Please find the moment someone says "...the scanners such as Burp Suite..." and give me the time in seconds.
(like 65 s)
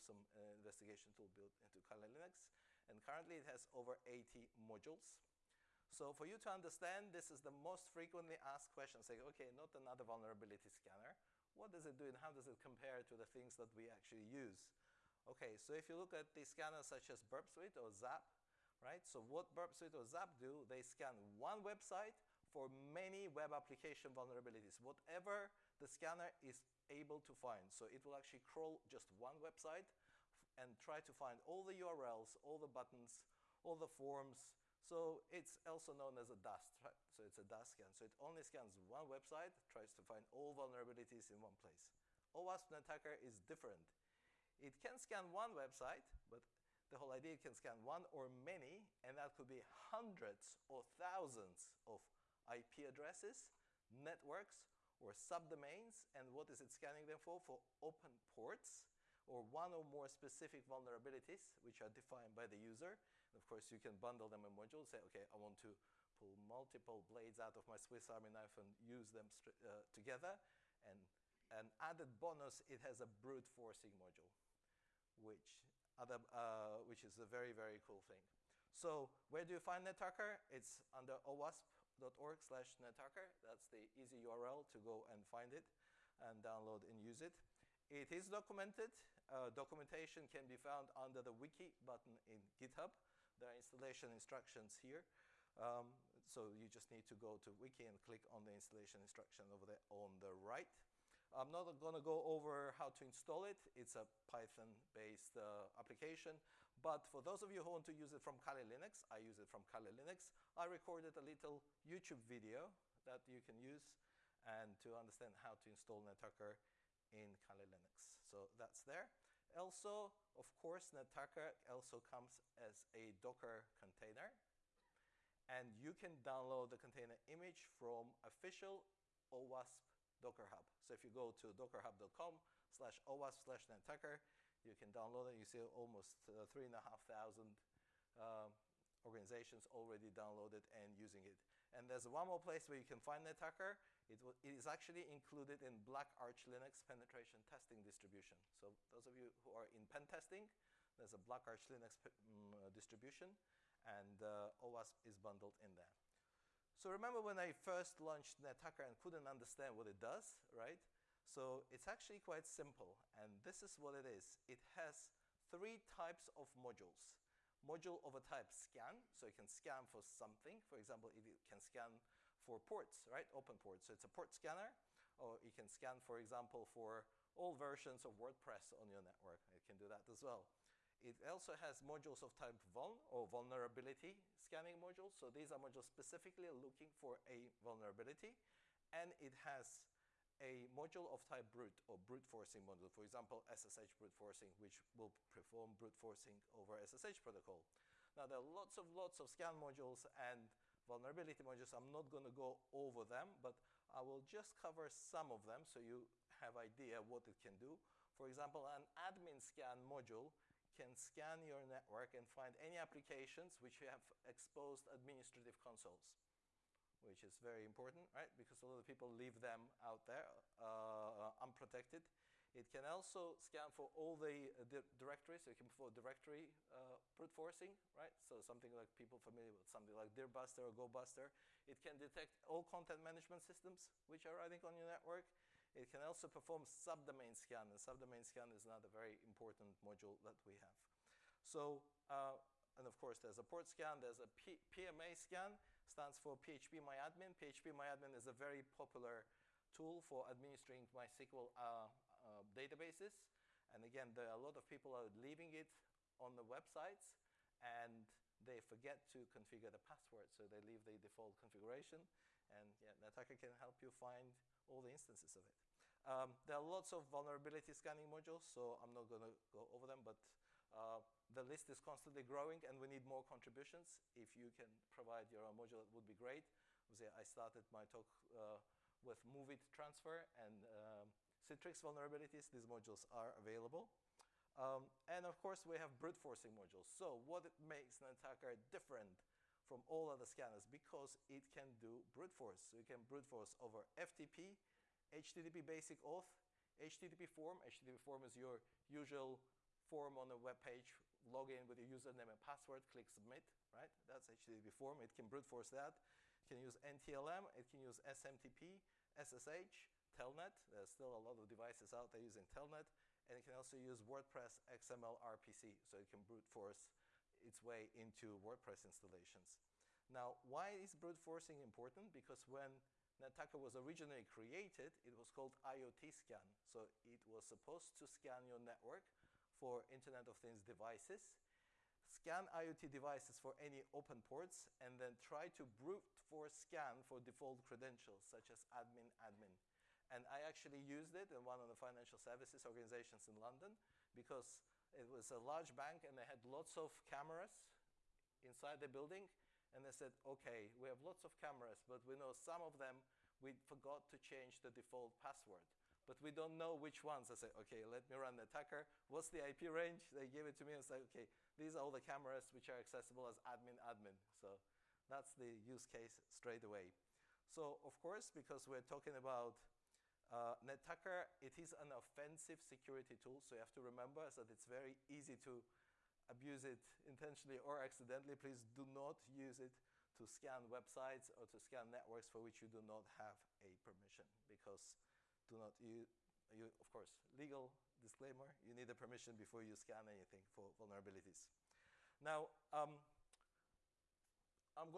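16 s.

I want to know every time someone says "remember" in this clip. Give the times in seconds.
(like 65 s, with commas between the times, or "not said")
156 s, 373 s.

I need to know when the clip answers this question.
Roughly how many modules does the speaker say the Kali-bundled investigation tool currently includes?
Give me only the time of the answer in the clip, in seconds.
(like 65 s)
3 s.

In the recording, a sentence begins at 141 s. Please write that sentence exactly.
And there's one more place where you can find the attacker.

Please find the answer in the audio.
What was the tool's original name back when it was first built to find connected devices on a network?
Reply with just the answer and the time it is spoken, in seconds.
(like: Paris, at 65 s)
IoT scan, at 325 s.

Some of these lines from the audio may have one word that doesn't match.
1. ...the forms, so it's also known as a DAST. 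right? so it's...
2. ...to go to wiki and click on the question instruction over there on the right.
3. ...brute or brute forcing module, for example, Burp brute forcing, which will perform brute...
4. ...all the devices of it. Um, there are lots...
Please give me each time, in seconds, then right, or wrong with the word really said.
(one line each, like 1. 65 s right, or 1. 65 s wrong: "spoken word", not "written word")
1. 33 s right
2. 97 s wrong: "installation", not "question"
3. 191 s wrong: "SSH", not "Burp"
4. 264 s wrong: "instances", not "devices".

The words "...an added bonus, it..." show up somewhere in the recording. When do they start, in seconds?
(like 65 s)
71 s.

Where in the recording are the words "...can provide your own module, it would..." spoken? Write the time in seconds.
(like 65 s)
274 s.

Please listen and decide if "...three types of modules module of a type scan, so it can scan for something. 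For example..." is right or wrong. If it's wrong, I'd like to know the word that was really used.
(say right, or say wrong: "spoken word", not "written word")
right.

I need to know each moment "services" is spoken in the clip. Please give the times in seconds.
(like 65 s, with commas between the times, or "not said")
342 s.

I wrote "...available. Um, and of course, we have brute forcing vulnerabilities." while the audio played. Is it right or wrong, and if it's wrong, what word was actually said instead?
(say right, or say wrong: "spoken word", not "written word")
wrong: "modules", not "vulnerabilities".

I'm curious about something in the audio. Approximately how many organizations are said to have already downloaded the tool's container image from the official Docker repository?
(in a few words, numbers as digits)
3,500.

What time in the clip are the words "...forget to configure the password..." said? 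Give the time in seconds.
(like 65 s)
258 s.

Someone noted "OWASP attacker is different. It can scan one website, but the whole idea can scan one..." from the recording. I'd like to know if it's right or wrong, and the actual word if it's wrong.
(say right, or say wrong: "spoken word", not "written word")
right.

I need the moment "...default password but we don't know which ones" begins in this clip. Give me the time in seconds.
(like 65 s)
354 s.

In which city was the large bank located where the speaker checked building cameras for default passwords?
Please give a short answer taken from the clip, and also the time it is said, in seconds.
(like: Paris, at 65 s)
London, at 343 s.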